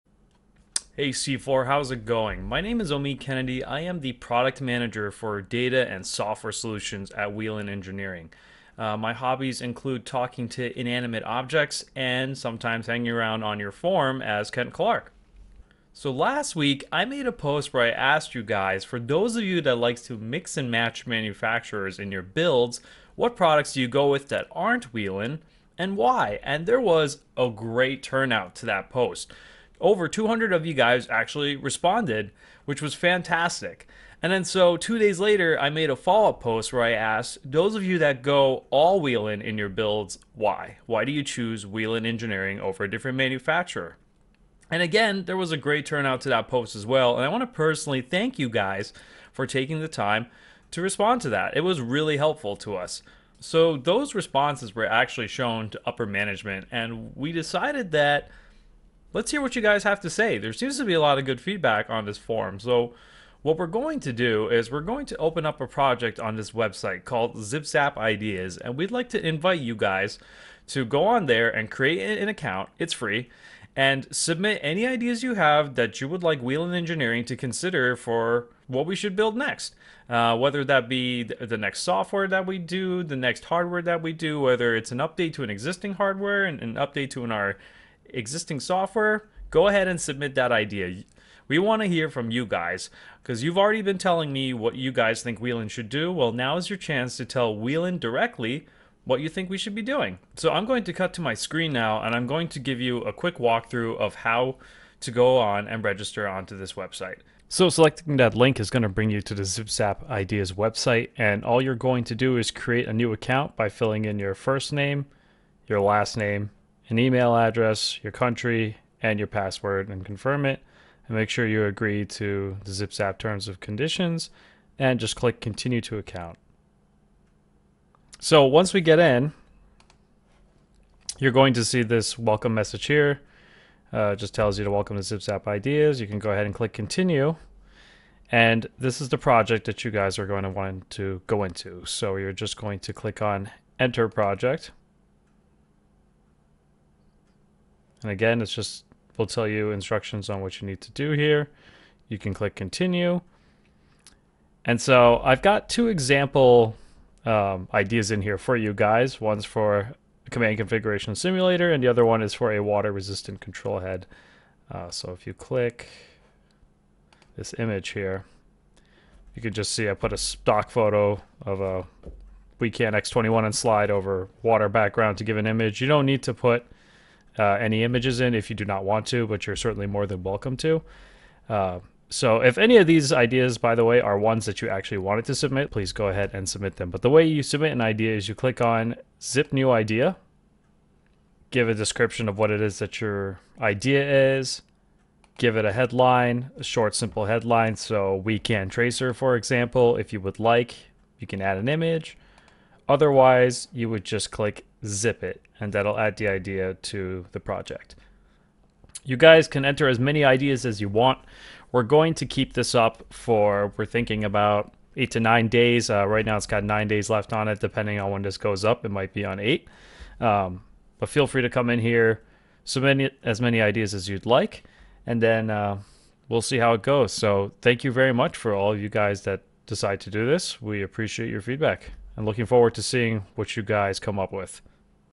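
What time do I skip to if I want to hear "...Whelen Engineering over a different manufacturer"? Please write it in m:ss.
0:41.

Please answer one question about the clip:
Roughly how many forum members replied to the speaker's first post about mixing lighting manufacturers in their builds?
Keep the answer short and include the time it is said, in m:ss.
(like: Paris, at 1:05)
Over 200, at 0:29.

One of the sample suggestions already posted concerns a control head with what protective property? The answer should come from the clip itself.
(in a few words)
Water resistant.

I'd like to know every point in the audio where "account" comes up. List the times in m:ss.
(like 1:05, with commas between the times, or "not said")
1:12, 1:53, 2:05.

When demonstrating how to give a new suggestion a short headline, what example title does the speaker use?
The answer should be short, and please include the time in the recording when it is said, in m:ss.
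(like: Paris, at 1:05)
We Can Tracer, at 3:18.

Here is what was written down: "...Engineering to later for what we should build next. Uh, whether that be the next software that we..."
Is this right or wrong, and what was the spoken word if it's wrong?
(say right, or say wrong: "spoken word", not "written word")
wrong: "consider", not "later".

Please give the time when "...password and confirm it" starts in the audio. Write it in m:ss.
1:59.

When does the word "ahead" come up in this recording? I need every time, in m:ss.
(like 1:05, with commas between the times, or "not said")
1:29, 2:16, 3:06.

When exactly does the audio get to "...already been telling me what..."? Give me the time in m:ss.
1:33.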